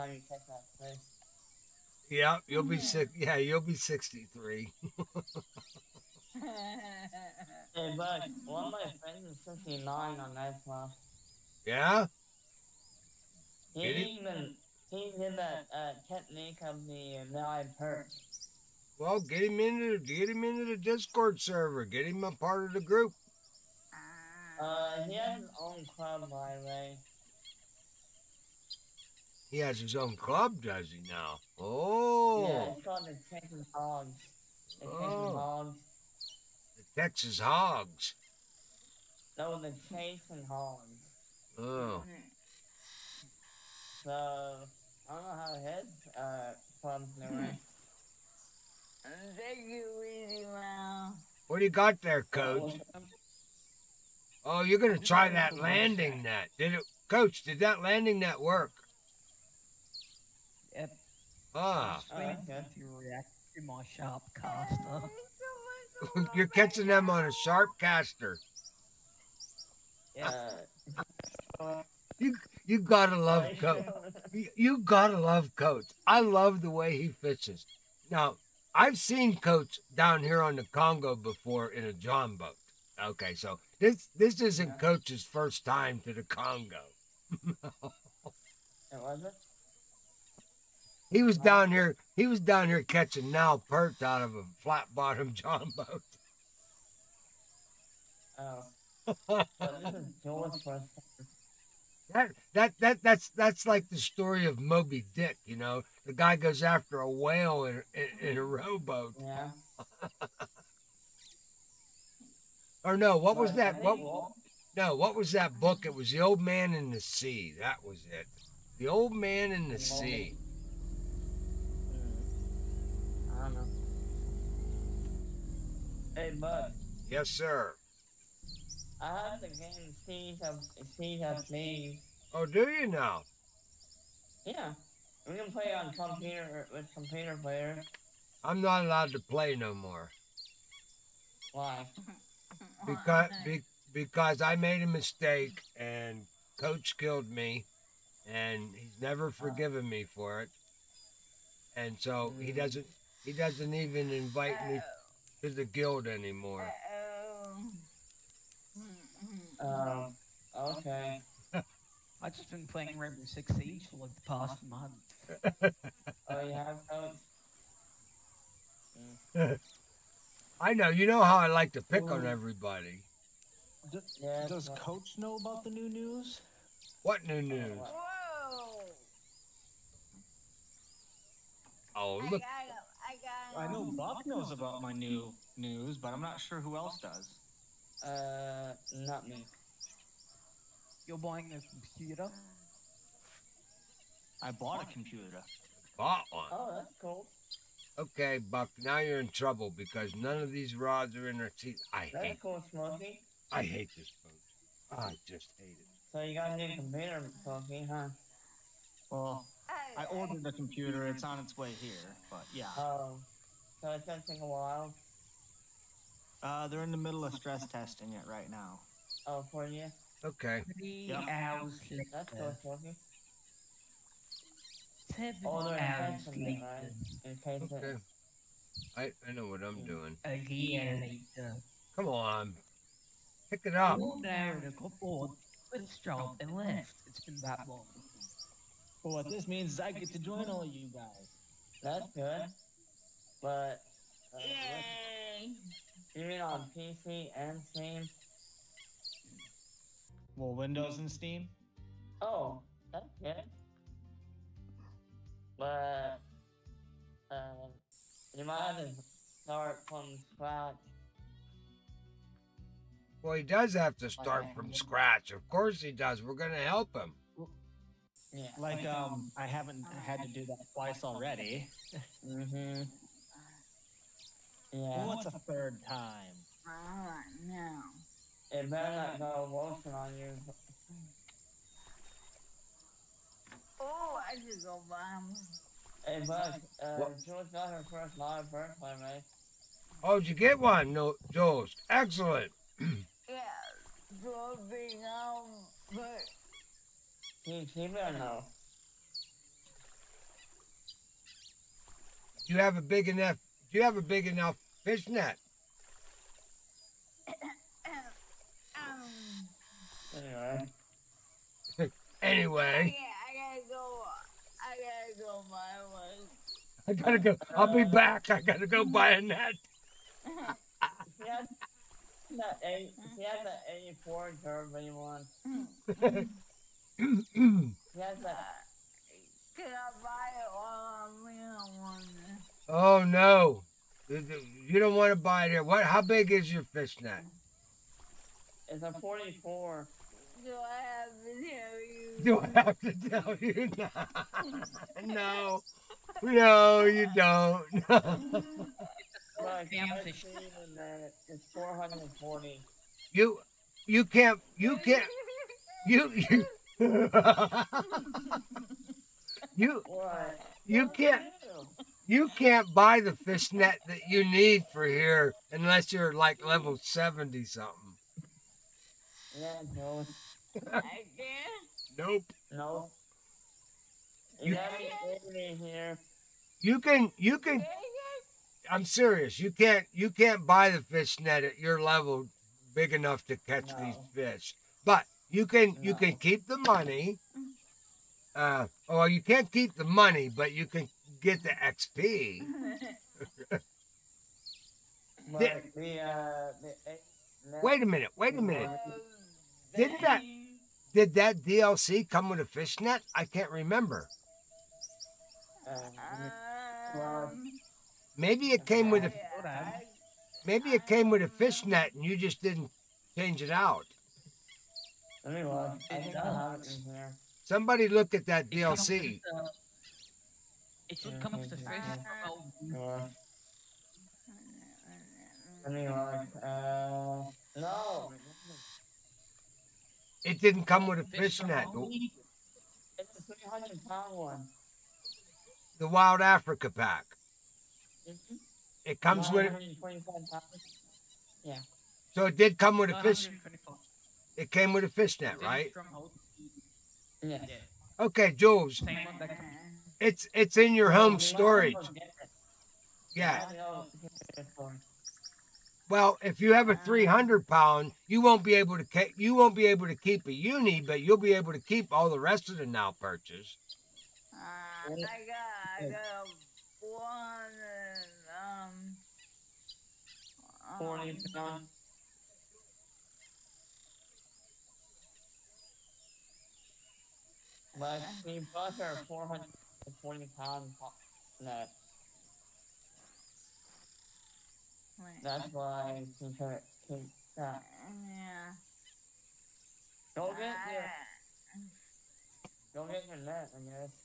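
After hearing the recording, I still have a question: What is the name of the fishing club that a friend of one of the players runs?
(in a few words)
The Chasing Hogs.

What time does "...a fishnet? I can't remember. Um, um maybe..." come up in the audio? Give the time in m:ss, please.
6:42.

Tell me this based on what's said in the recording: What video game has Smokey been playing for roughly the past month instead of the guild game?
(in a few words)
Rainbow Six Siege.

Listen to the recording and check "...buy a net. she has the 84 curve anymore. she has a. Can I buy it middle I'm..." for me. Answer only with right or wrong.
wrong.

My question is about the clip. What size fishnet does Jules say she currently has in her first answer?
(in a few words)
44.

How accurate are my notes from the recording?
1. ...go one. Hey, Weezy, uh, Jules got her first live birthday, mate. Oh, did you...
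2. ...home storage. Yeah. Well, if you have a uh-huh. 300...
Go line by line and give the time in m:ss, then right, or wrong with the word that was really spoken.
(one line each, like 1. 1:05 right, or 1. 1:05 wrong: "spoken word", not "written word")
1. 4:44 wrong: "Buzz", not "Weezy"
2. 7:30 right.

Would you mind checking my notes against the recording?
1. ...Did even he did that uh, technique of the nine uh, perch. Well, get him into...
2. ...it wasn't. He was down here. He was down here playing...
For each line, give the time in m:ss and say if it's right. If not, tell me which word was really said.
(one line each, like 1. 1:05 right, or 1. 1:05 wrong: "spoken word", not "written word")
1. 0:13 right
2. 1:27 wrong: "catching", not "playing".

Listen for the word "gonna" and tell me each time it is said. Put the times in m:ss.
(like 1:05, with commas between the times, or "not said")
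0:54, 3:34.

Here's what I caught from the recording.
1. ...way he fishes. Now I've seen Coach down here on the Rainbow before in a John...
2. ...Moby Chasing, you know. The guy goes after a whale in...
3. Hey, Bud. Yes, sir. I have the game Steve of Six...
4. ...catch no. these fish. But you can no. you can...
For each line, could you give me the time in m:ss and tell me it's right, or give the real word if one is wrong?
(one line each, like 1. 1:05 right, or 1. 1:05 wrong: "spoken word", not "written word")
1. 1:16 wrong: "Congo", not "Rainbow"
2. 1:44 wrong: "Dick", not "Chasing"
3. 2:06 wrong: "Steve", not "Six"
4. 6:23 right.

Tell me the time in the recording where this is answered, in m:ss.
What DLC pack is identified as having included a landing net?
7:15.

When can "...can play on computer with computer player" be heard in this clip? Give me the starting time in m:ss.
2:15.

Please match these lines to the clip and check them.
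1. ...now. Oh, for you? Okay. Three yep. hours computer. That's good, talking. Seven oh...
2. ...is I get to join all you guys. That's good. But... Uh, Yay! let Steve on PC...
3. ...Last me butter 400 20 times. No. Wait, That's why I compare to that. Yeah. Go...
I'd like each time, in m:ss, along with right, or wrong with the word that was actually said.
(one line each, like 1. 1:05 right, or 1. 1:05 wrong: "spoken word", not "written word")
1. 3:38 wrong: "later", not "computer"
2. 3:59 wrong: "Streaming", not "Steve"
3. 7:57 right.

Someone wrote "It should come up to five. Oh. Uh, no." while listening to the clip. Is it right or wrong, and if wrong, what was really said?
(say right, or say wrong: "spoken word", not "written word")
wrong: "three", not "five".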